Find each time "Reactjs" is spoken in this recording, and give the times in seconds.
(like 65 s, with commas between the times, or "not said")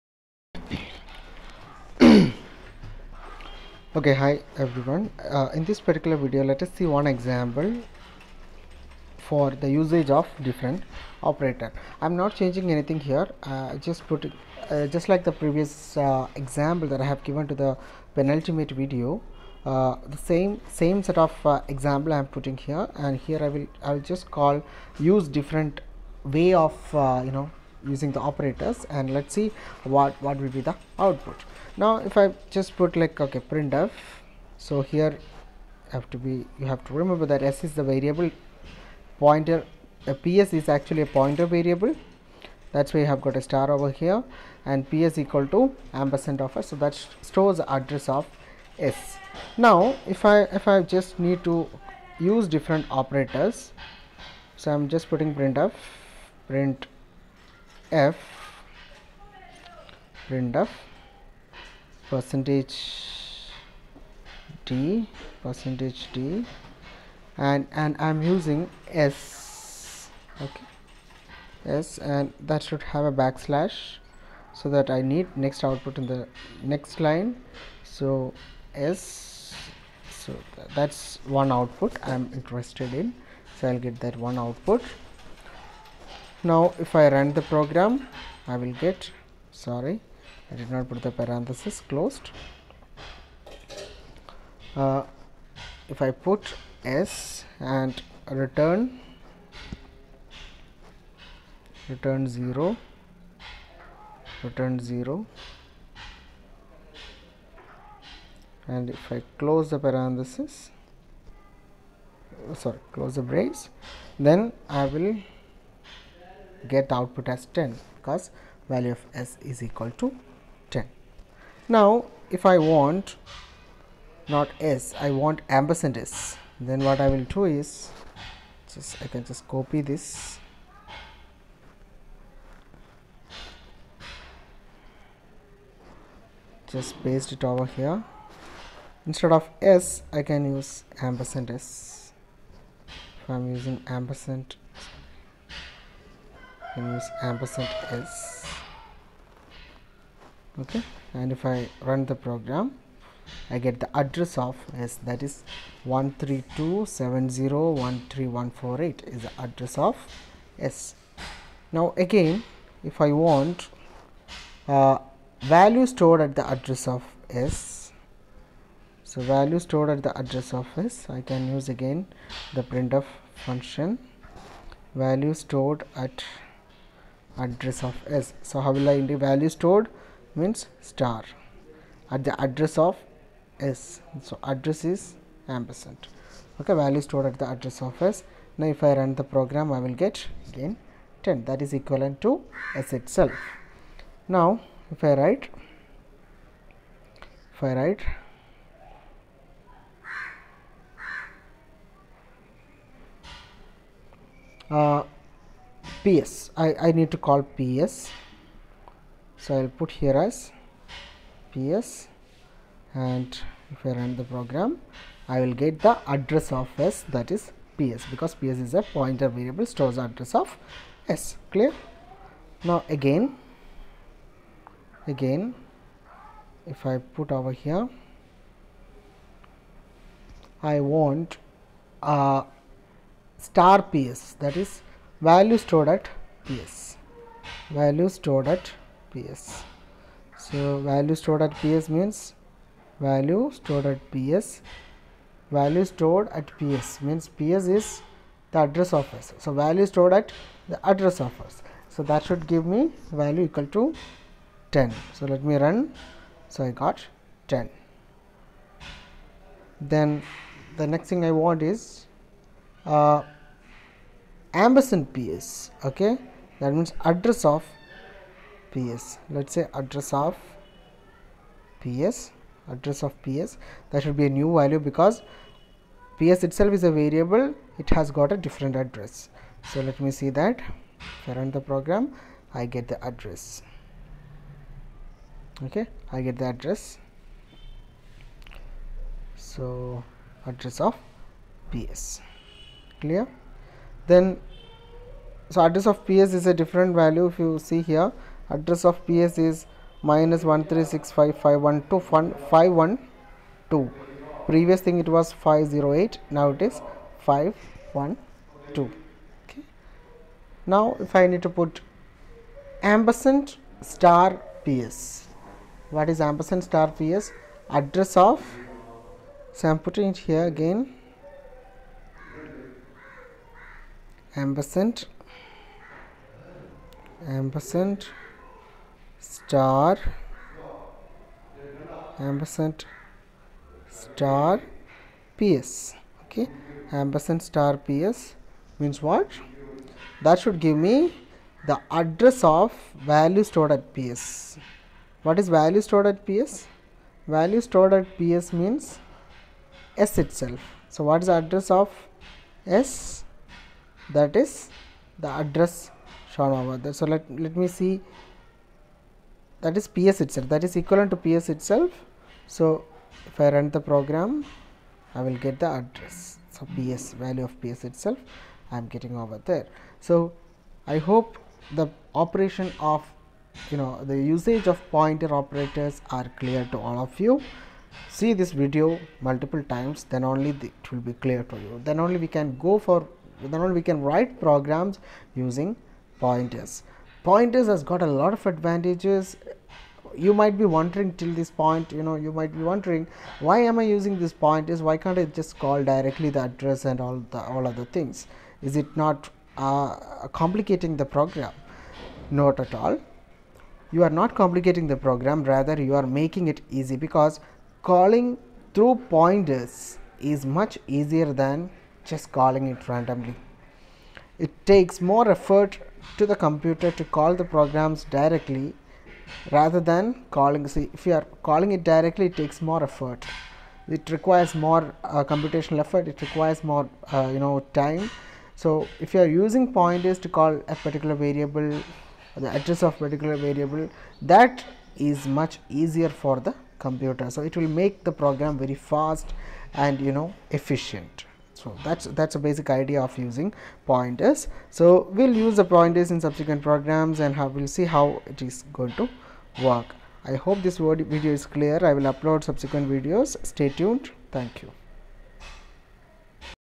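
not said.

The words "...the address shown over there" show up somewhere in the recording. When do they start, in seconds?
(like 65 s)
355 s.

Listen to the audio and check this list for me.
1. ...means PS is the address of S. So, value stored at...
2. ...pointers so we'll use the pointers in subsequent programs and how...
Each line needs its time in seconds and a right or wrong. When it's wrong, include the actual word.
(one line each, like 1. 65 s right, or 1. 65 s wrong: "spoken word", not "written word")
1. 247 s right
2. 443 s right.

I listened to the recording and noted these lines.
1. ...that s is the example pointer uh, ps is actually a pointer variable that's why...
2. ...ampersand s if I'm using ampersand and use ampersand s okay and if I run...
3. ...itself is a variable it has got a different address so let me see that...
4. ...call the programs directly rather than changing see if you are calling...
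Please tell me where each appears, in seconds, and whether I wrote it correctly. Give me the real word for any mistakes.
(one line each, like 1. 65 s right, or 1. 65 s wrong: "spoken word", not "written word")
1. 37 s wrong: "variable", not "example"
2. 141 s right
3. 276 s right
4. 417 s wrong: "calling", not "changing".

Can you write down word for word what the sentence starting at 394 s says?
Why can't I just call directly the address and all the all other things?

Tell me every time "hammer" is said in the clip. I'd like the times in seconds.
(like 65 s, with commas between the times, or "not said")
not said.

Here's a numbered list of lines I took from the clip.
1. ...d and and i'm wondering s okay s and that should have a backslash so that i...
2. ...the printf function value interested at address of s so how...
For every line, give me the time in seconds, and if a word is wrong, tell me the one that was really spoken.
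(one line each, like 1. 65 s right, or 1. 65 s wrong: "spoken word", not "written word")
1. 66 s wrong: "using", not "wondering"
2. 172 s wrong: "stored", not "interested".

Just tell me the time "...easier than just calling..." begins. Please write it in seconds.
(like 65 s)
410 s.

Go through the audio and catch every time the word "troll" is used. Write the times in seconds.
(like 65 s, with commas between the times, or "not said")
not said.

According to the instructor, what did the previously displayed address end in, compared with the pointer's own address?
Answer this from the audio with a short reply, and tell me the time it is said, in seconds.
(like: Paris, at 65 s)
508, at 305 s.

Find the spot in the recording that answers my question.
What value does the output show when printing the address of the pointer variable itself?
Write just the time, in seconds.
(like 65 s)
300 s.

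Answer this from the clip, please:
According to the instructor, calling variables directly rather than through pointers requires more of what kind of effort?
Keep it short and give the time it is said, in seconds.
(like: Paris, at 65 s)
computational effort, at 425 s.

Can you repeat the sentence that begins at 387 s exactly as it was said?
Pointers has got a lot of advantages.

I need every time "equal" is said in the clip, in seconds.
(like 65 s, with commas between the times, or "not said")
45 s, 119 s, 253 s.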